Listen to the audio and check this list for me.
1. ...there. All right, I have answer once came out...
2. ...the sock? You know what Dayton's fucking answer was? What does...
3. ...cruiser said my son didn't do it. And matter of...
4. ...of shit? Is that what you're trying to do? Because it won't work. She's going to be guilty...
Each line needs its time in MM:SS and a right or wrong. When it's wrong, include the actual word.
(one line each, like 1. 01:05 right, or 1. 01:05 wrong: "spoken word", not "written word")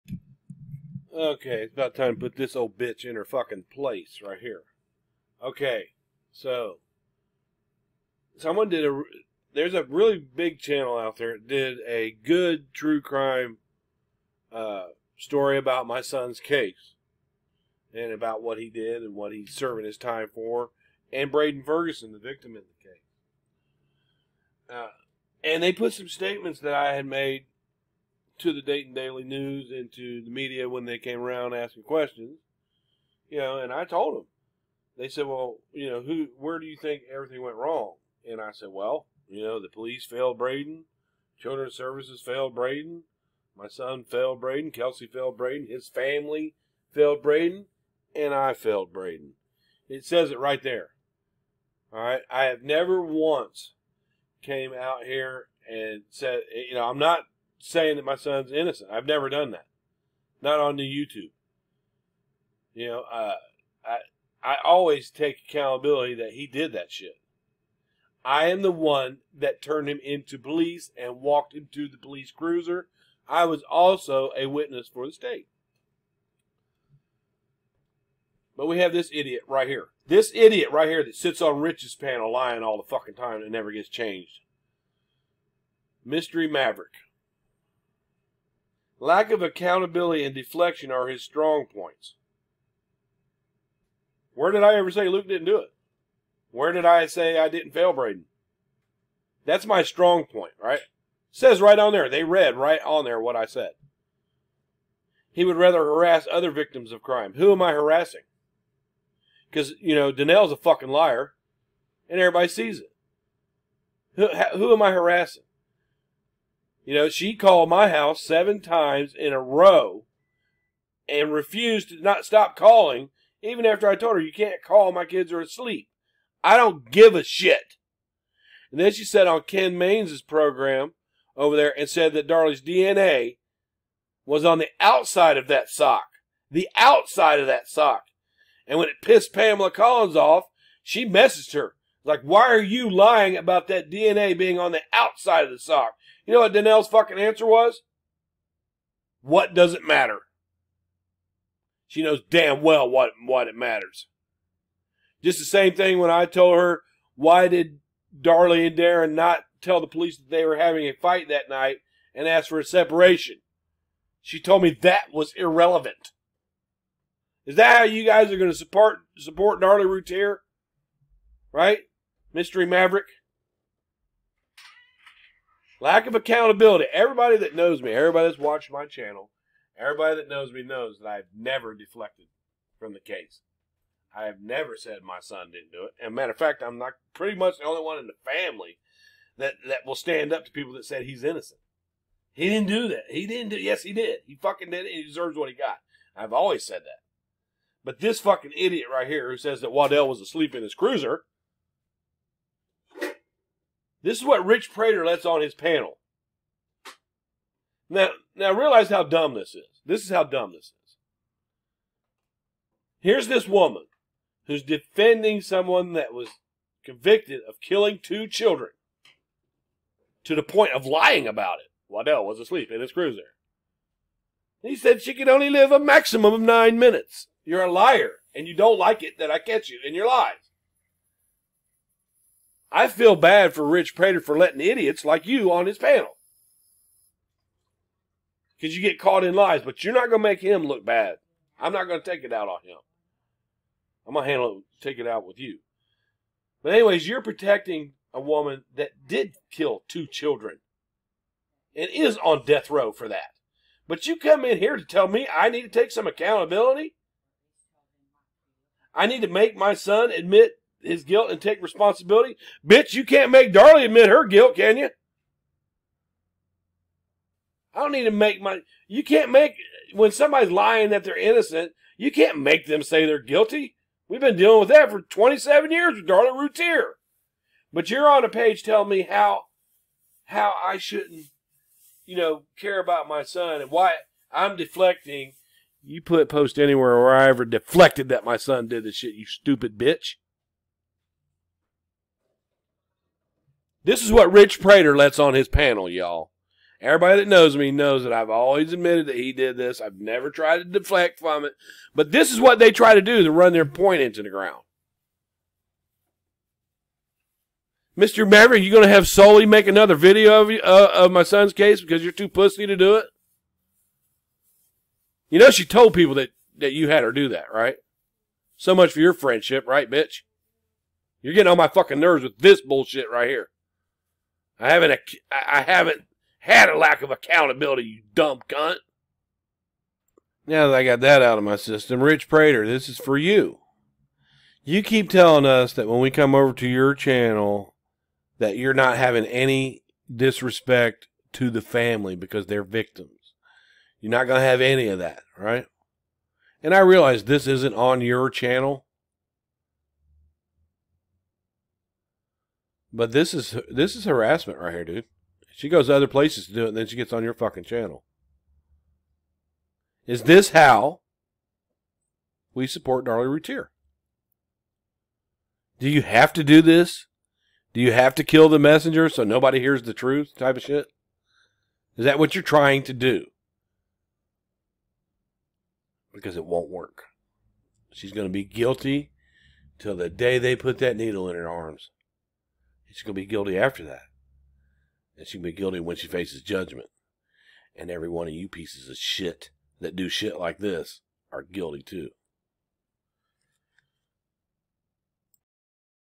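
1. 00:50 wrong: "never", not "answer"
2. 02:25 wrong: "Danelle", not "Dayton"
3. 03:04 wrong: "never", not "cruiser"
4. 06:10 right.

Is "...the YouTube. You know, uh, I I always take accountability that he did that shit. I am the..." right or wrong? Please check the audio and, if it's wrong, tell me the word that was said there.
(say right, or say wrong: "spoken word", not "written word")
right.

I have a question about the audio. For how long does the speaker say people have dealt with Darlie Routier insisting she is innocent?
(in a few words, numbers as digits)
27 years.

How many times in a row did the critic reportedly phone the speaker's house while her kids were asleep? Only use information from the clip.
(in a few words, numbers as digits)
7.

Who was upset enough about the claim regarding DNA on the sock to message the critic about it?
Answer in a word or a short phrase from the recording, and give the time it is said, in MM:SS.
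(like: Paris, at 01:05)
Pamela Collins, at 02:19.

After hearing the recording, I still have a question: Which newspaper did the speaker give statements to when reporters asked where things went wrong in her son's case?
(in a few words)
Dayton Daily News.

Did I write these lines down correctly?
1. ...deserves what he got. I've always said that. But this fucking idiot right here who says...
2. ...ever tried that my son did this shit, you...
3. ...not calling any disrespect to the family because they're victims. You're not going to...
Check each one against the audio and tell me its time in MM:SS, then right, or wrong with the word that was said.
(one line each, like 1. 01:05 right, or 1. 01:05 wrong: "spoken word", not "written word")
1. 03:15 right
2. 04:47 wrong: "deflected", not "tried"
3. 05:38 wrong: "having", not "calling".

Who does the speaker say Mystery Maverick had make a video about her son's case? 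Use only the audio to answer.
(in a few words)
Sully.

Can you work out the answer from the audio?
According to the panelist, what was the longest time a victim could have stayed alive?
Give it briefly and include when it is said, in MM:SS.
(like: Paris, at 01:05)
9 minutes, at 03:46.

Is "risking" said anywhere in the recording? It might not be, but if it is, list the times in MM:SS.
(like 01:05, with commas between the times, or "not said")
not said.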